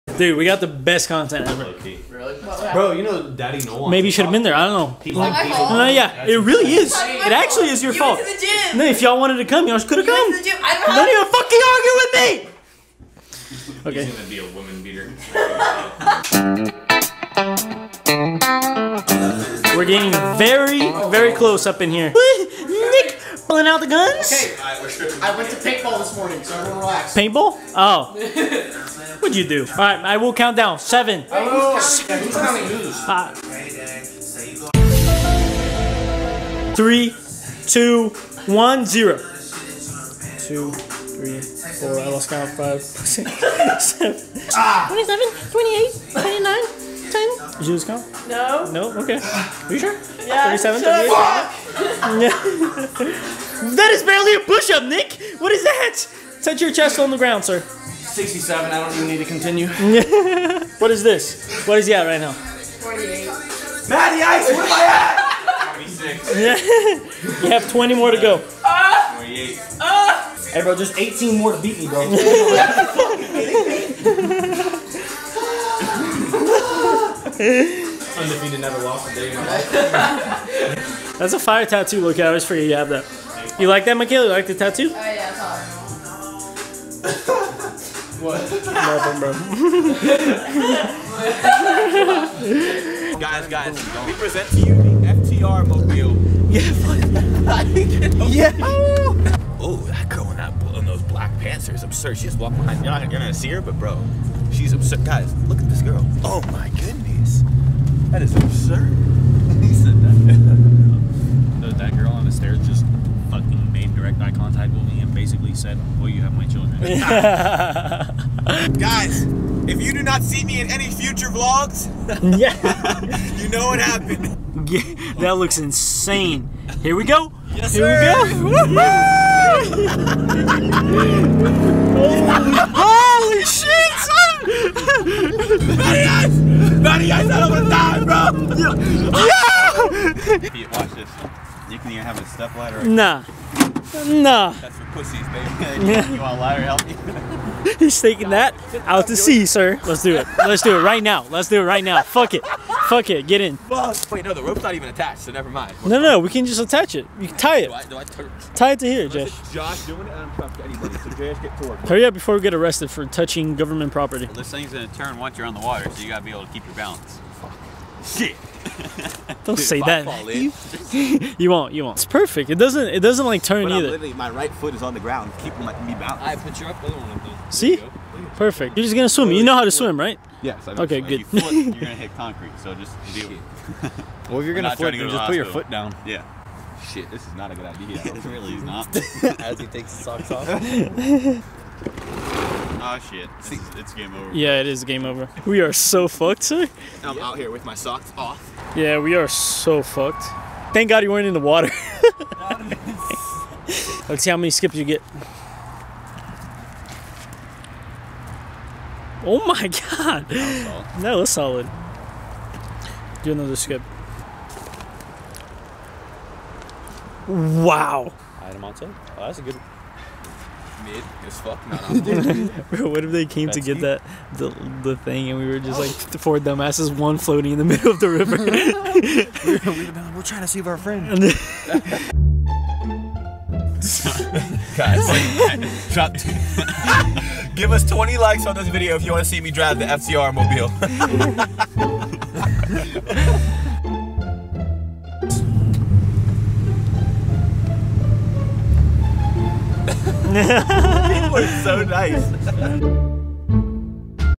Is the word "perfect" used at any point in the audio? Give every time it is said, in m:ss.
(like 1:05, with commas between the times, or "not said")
2:52, 2:58.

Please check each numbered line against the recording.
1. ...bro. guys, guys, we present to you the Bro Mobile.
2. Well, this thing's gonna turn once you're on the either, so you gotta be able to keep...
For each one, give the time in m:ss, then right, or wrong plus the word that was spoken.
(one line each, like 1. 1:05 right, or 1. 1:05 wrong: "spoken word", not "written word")
1. 1:33 wrong: "FTR", not "Bro"
2. 2:44 wrong: "water", not "either".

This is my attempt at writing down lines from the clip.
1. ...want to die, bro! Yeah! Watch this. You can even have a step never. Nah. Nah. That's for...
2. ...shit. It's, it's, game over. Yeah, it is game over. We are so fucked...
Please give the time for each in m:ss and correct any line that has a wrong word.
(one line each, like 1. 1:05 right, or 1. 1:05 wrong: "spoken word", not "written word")
1. 2:17 wrong: "ladder", not "never"
2. 3:13 right.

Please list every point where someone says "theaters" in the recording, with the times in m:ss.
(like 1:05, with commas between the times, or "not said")
not said.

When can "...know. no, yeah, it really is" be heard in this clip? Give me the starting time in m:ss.
0:05.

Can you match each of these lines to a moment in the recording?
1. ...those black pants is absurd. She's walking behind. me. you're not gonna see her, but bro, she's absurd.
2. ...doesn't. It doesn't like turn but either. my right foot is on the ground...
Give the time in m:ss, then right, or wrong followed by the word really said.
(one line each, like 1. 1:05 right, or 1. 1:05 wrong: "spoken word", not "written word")
1. 1:40 right
2. 2:52 right.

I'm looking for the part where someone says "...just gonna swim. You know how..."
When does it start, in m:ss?
2:58.